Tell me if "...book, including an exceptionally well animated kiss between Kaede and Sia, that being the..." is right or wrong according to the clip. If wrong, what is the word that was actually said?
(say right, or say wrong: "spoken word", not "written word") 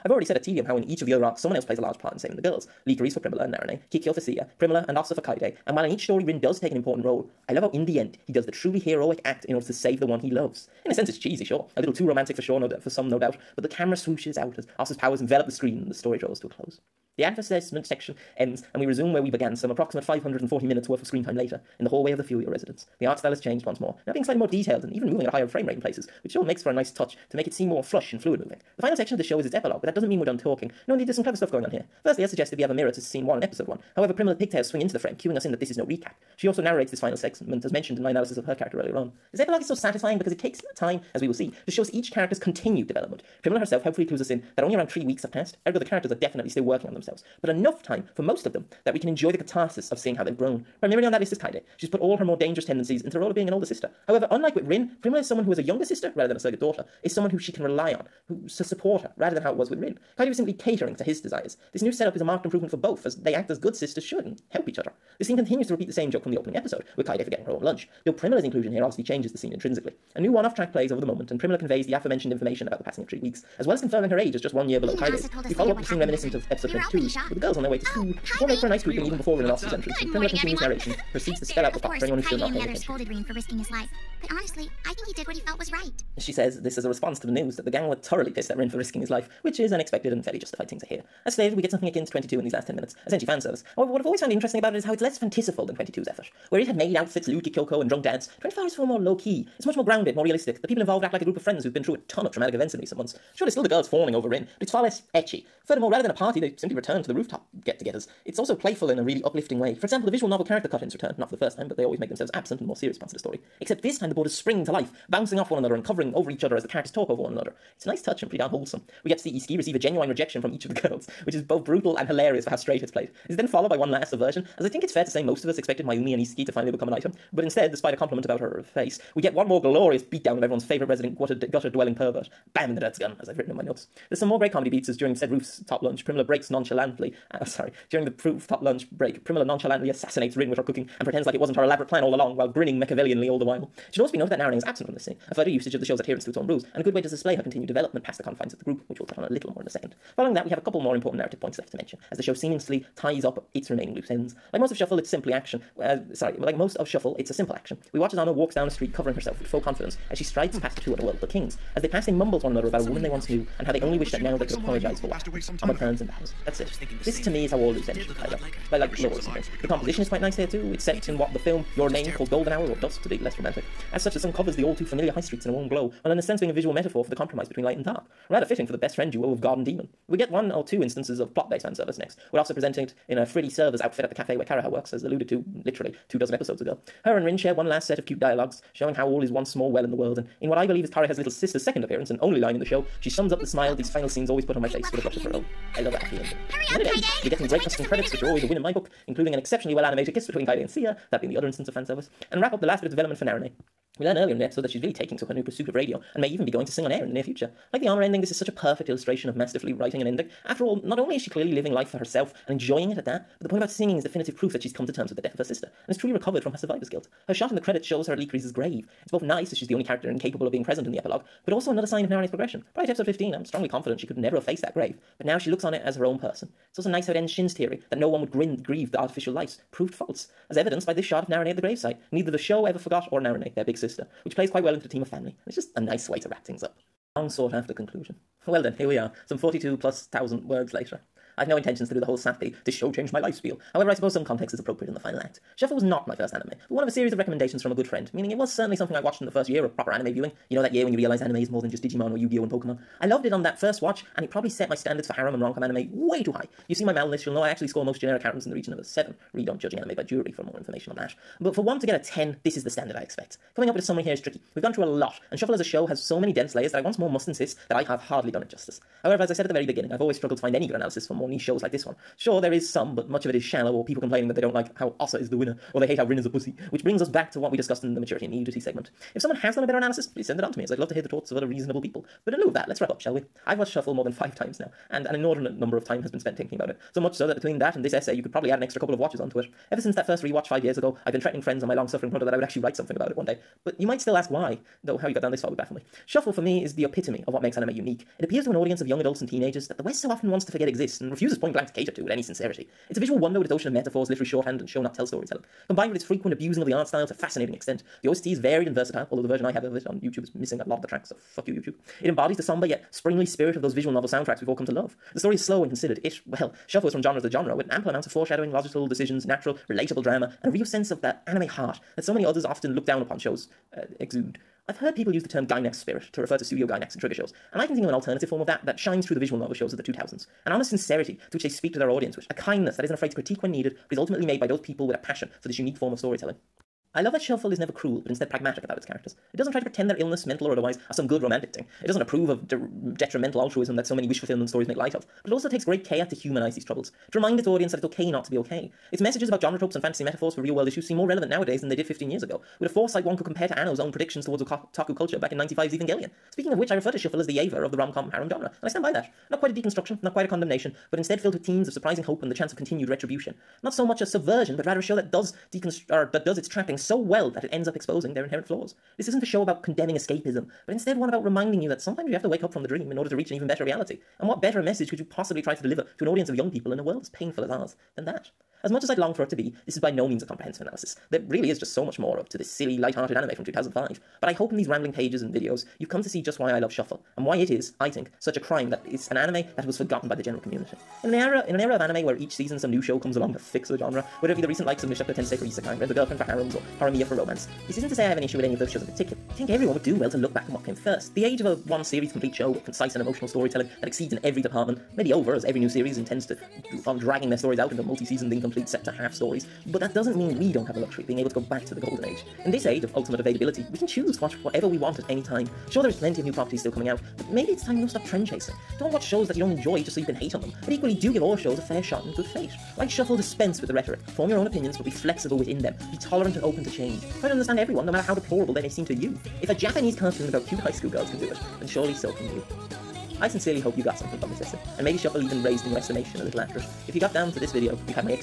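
right.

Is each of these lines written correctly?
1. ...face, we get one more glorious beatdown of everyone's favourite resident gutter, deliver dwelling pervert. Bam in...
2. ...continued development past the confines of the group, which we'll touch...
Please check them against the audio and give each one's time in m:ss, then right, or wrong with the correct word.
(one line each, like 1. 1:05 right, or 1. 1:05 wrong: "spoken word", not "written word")
1. 2:08 wrong: "gutter", not "deliver"
2. 2:27 right.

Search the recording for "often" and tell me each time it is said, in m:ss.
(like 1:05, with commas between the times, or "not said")
5:00, 5:22.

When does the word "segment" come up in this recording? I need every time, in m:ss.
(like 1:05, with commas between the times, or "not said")
0:37, 4:38.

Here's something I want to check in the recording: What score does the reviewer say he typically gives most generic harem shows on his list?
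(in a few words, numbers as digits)
7.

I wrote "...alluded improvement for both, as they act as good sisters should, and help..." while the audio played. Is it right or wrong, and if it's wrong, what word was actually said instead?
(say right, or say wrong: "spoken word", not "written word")
wrong: "marked", not "alluded".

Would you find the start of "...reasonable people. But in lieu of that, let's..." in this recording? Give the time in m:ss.
4:41.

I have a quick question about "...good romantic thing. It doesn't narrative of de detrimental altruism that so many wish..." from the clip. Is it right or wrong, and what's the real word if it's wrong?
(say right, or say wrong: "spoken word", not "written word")
wrong: "approve", not "narrative".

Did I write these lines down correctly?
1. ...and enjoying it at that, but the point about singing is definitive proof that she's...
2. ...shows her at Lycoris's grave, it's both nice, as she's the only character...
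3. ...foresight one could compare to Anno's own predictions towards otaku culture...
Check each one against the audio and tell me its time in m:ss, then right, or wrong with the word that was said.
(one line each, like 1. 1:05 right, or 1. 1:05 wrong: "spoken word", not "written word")
1. 3:32 right
2. 3:37 right
3. 5:52 right.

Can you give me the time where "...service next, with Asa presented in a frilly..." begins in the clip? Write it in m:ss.
3:01.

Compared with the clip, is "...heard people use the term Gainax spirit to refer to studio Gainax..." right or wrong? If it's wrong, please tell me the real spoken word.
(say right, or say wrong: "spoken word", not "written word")
right.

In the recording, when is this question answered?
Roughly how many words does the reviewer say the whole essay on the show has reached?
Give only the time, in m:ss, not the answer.
3:59.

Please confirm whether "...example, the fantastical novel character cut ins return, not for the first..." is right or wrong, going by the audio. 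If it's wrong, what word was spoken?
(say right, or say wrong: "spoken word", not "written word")
wrong: "visual", not "fantastical".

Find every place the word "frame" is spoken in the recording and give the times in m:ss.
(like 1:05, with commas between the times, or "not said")
0:25, 0:34.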